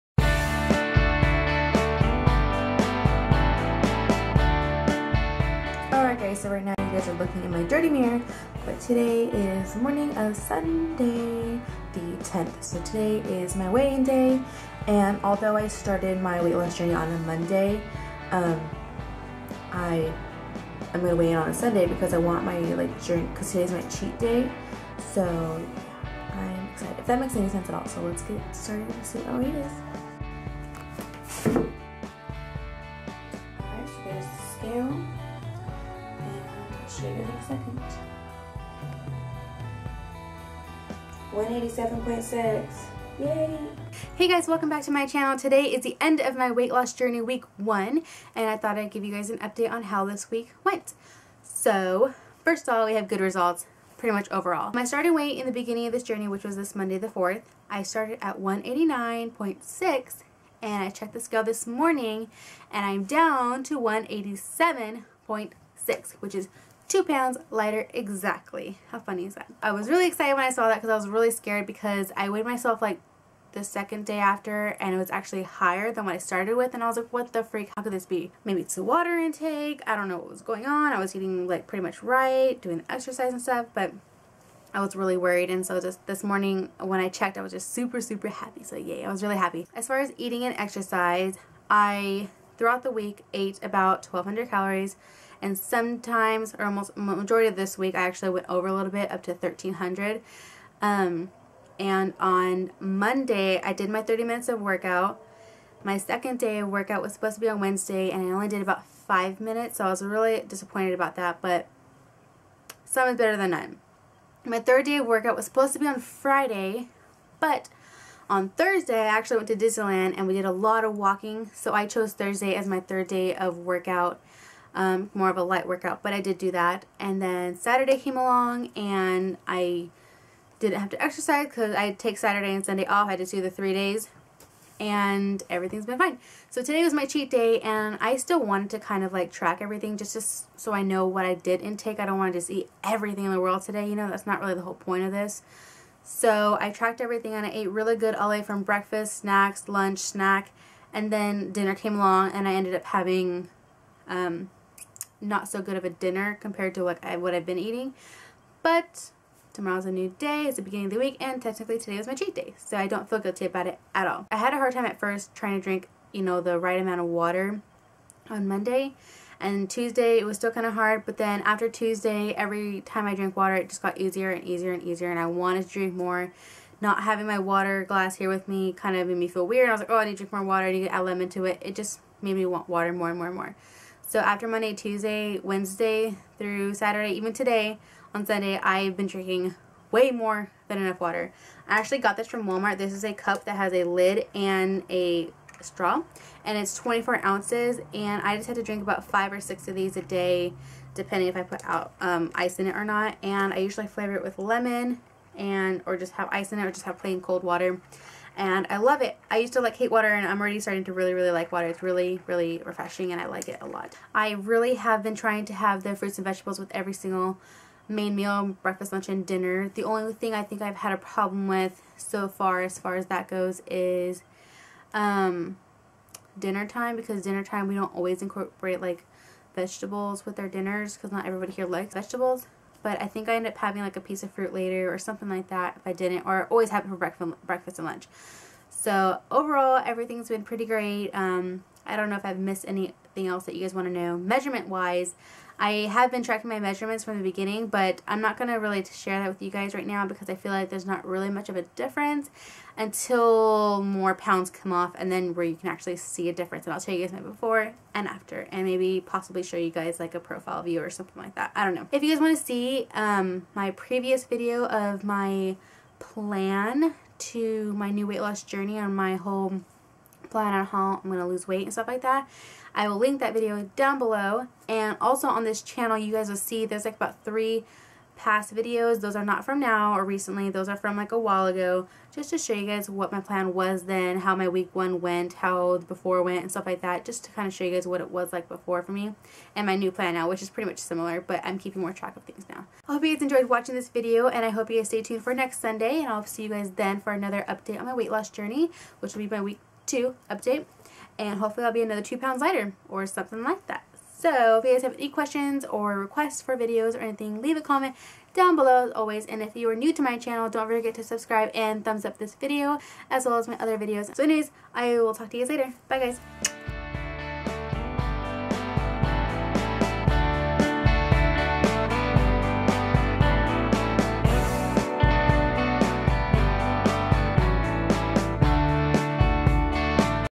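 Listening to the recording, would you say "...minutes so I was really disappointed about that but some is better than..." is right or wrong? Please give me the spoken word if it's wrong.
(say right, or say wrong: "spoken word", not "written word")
right.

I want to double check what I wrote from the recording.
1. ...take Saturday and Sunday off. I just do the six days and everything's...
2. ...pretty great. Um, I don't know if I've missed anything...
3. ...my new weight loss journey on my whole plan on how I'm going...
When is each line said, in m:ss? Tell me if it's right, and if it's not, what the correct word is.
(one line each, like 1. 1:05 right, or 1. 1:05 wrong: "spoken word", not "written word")
1. 2:11 wrong: "three", not "six"
2. 4:00 right
3. 4:27 right.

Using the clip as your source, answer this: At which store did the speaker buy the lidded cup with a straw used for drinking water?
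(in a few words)
Walmart.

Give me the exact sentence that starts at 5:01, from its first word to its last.
And hopefully I'll be another two pounds lighter or something like that.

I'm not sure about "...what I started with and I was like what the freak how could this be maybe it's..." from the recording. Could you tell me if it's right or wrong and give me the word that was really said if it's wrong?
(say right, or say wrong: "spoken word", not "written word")
right.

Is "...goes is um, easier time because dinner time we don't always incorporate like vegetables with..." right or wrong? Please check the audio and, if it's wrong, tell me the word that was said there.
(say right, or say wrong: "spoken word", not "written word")
wrong: "dinner", not "easier".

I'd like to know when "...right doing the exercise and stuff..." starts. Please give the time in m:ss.
1:22.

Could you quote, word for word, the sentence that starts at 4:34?
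And also on this channel, you guys will see there's like about three past videos.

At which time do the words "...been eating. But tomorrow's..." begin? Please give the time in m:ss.
2:37.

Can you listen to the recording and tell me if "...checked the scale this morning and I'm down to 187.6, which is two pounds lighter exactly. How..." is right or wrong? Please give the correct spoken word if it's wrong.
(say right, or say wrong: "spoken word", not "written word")
right.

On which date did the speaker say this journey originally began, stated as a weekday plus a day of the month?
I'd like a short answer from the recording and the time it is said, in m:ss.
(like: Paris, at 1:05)
Monday the 4th, at 0:56.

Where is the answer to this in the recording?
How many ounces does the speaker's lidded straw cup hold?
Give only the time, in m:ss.
3:16.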